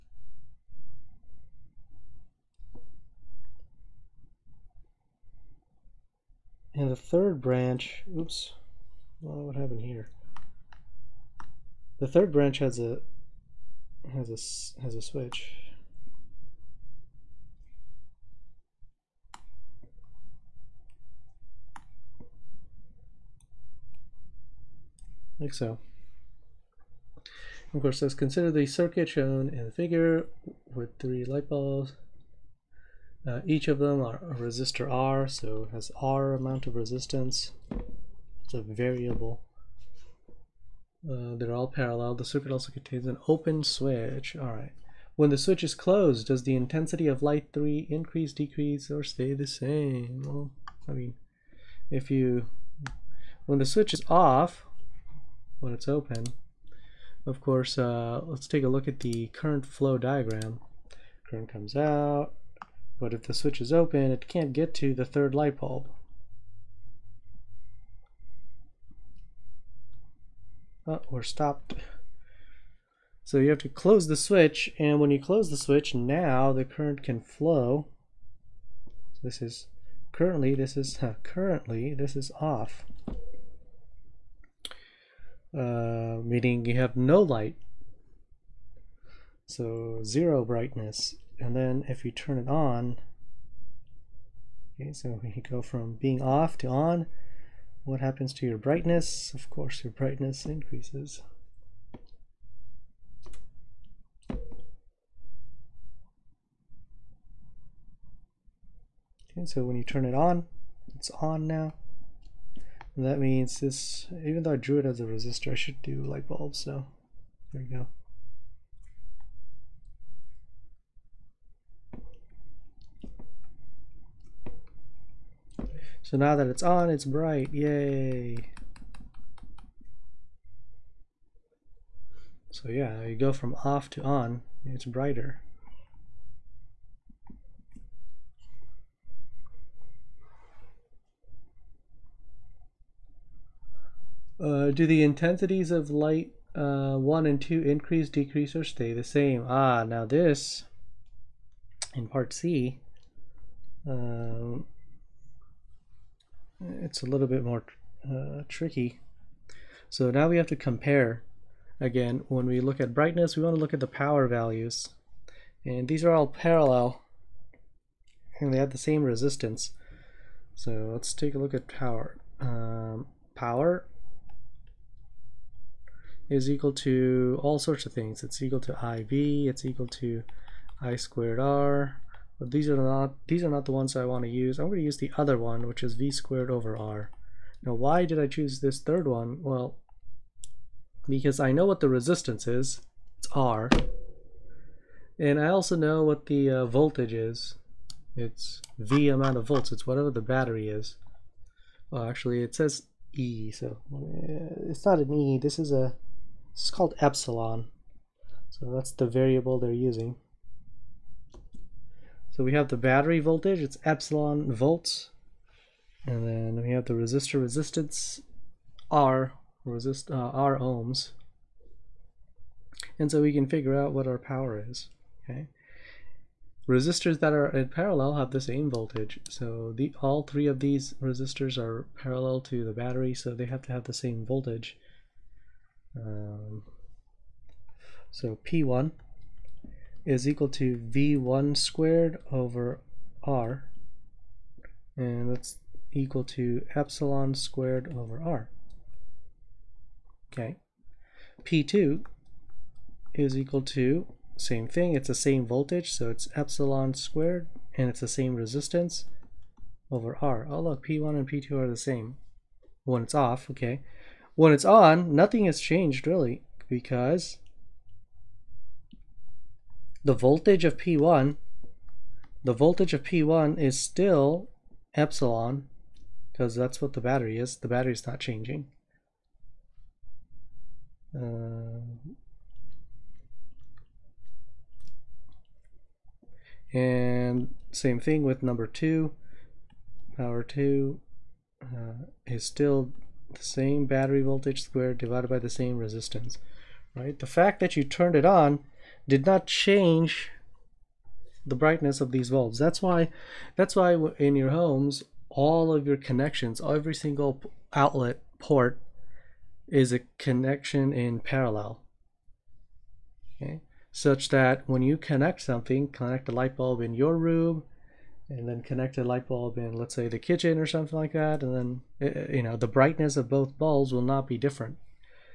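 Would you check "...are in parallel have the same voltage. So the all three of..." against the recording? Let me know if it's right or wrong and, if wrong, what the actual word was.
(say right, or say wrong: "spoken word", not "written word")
right.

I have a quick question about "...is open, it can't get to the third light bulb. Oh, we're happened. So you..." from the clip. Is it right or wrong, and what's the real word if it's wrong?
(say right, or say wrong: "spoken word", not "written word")
wrong: "stopped", not "happened".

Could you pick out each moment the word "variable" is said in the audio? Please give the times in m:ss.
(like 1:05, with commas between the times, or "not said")
0:38, 3:29.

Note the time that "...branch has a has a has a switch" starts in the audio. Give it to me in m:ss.
0:12.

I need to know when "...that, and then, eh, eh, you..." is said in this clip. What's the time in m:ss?
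5:21.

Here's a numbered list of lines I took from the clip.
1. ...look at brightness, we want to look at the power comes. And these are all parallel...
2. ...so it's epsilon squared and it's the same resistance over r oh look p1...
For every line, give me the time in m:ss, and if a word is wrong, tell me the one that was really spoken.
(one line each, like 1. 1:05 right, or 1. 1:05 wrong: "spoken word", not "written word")
1. 2:42 wrong: "values", not "comes"
2. 4:15 right.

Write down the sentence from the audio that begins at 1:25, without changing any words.
Uh, meaning you have no light.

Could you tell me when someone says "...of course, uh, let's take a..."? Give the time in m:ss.
0:57.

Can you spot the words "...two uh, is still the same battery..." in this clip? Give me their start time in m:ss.
4:50.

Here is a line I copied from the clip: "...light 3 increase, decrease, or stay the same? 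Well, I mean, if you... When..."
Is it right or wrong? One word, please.
right.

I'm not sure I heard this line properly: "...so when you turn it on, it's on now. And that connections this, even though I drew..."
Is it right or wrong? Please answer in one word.
wrong.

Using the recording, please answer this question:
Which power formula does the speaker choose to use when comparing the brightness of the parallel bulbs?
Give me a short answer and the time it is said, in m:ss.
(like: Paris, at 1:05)
V squared over R, at 3:05.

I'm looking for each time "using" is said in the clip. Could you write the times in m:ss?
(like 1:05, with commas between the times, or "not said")
3:29.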